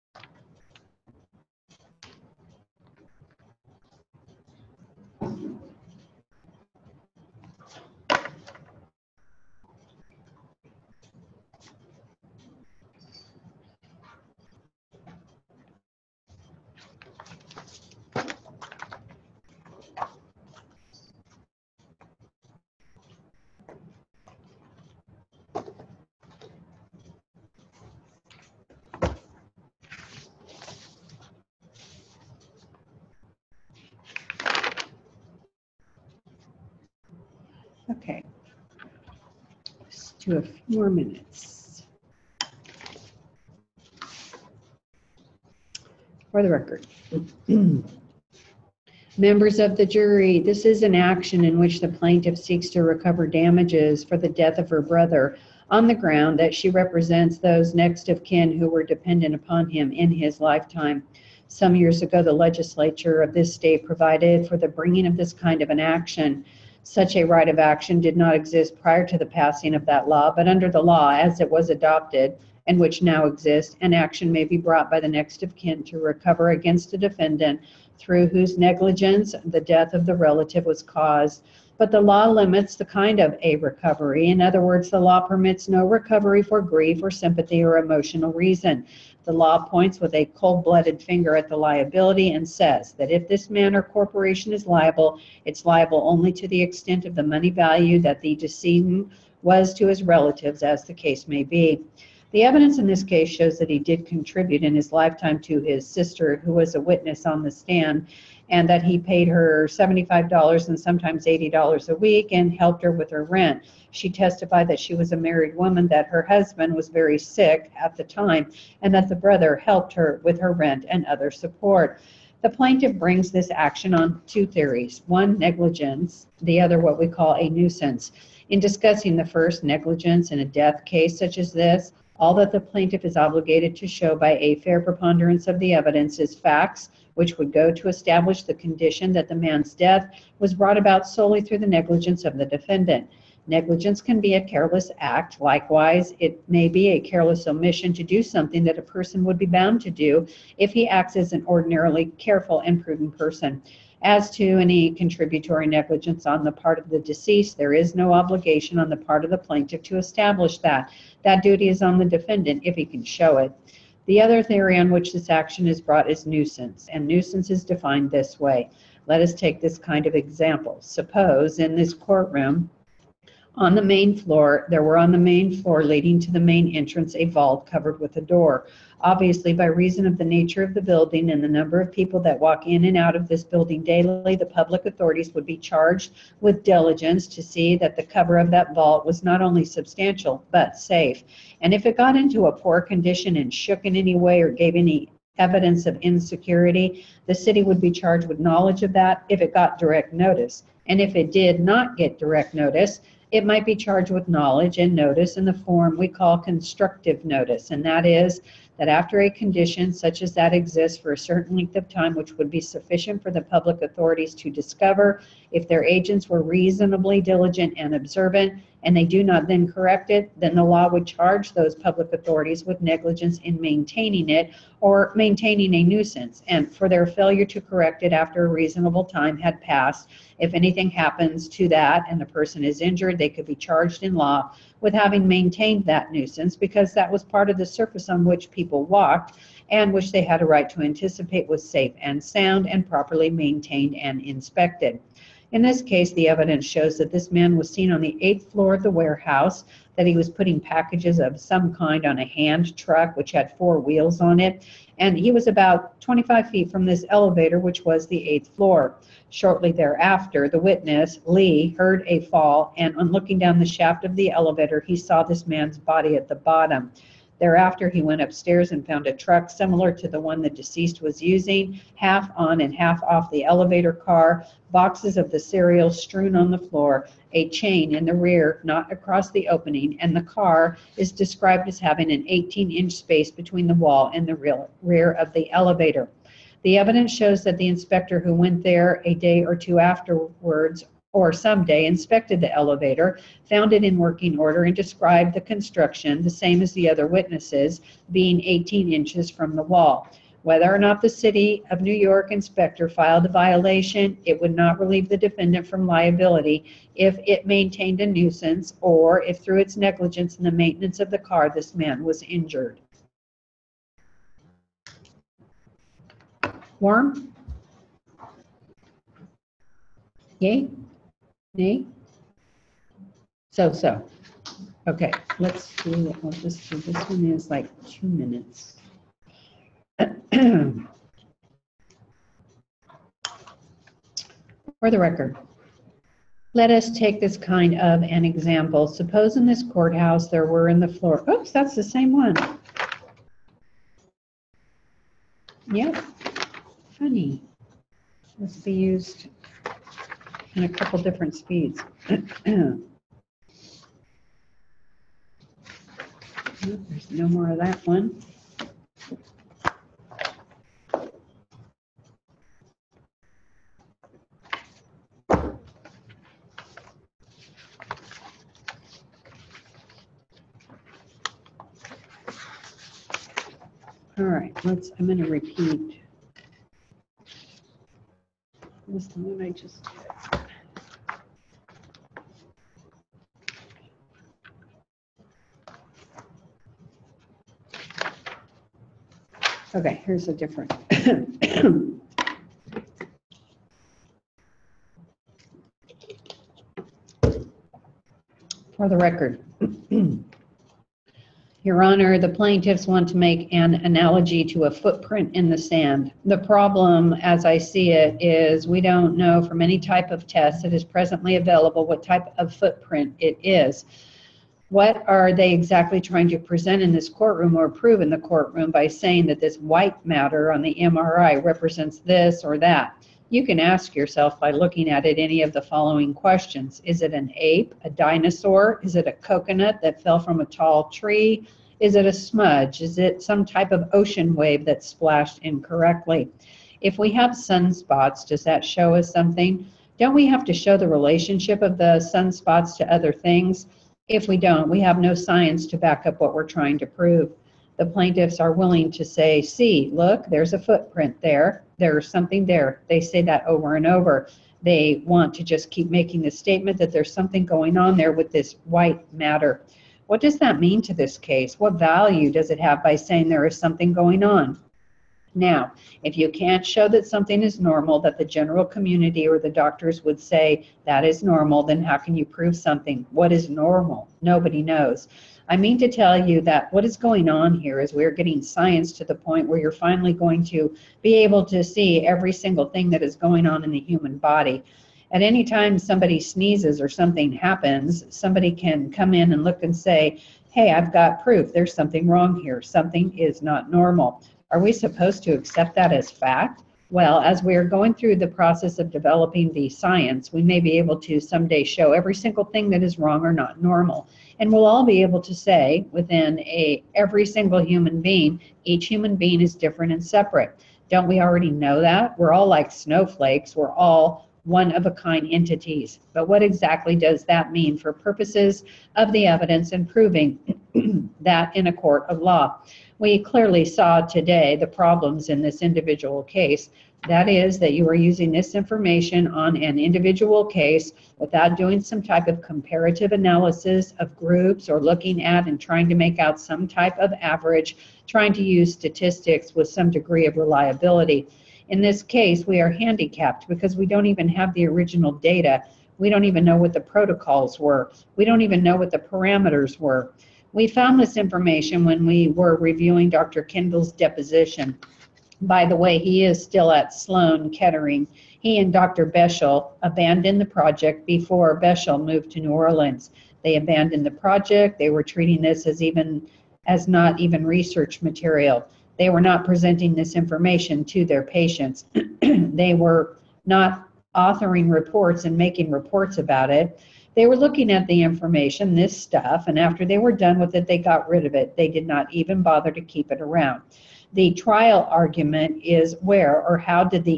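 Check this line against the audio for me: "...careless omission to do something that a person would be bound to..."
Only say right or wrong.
right.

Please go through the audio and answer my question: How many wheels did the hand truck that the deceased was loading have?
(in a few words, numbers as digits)
4.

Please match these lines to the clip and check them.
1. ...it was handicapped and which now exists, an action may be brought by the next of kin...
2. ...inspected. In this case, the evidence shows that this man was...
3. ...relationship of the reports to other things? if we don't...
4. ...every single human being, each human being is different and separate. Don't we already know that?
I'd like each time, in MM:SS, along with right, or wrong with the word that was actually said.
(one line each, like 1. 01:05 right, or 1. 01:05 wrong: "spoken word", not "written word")
1. 01:11 wrong: "adopted", not "handicapped"
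2. 04:04 right
3. 07:20 wrong: "sunspots", not "reports"
4. 08:26 right.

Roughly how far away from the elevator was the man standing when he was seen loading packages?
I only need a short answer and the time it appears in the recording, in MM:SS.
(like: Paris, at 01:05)
25 feet, at 04:16.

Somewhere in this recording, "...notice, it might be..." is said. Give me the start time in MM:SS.
03:22.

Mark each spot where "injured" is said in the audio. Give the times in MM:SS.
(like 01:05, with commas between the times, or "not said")
03:52, 05:12.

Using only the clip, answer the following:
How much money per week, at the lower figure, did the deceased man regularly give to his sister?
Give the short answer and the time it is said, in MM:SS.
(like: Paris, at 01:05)
$75, at 01:49.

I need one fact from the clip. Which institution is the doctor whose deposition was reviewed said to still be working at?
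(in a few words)
Sloan Kettering.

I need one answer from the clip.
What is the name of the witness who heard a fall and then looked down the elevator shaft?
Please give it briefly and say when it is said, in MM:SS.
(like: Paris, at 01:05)
Lee, at 04:21.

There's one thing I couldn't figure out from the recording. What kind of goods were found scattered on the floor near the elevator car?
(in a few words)
cereal.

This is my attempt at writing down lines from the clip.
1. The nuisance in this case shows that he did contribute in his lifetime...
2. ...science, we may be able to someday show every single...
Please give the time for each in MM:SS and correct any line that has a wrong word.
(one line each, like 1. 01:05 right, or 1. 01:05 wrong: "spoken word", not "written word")
1. 01:42 wrong: "evidence", not "nuisance"
2. 08:19 right.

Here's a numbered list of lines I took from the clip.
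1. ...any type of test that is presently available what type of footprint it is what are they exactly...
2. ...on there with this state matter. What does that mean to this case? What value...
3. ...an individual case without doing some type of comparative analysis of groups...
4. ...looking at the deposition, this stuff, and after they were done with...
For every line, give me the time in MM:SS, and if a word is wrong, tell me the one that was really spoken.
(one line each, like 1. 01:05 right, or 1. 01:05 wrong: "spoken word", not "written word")
1. 06:49 right
2. 07:37 wrong: "white", not "state"
3. 08:49 right
4. 09:37 wrong: "information", not "deposition".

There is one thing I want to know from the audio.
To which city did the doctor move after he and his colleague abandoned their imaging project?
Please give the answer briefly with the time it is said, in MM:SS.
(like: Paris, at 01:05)
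New Orleans, at 09:22.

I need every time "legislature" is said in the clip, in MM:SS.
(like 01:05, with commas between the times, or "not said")
01:02.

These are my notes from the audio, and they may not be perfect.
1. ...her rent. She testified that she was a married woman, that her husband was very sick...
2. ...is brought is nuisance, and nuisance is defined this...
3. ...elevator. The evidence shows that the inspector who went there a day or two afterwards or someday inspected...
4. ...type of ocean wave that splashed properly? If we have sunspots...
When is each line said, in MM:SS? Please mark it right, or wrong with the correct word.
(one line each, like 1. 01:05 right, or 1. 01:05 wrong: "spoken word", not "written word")
1. 01:53 right
2. 02:45 right
3. 04:45 right
4. 07:13 wrong: "incorrectly", not "properly".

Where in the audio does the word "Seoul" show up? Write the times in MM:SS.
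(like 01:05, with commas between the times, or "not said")
not said.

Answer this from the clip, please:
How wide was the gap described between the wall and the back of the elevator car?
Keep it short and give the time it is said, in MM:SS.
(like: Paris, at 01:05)
18 inches, at 04:42.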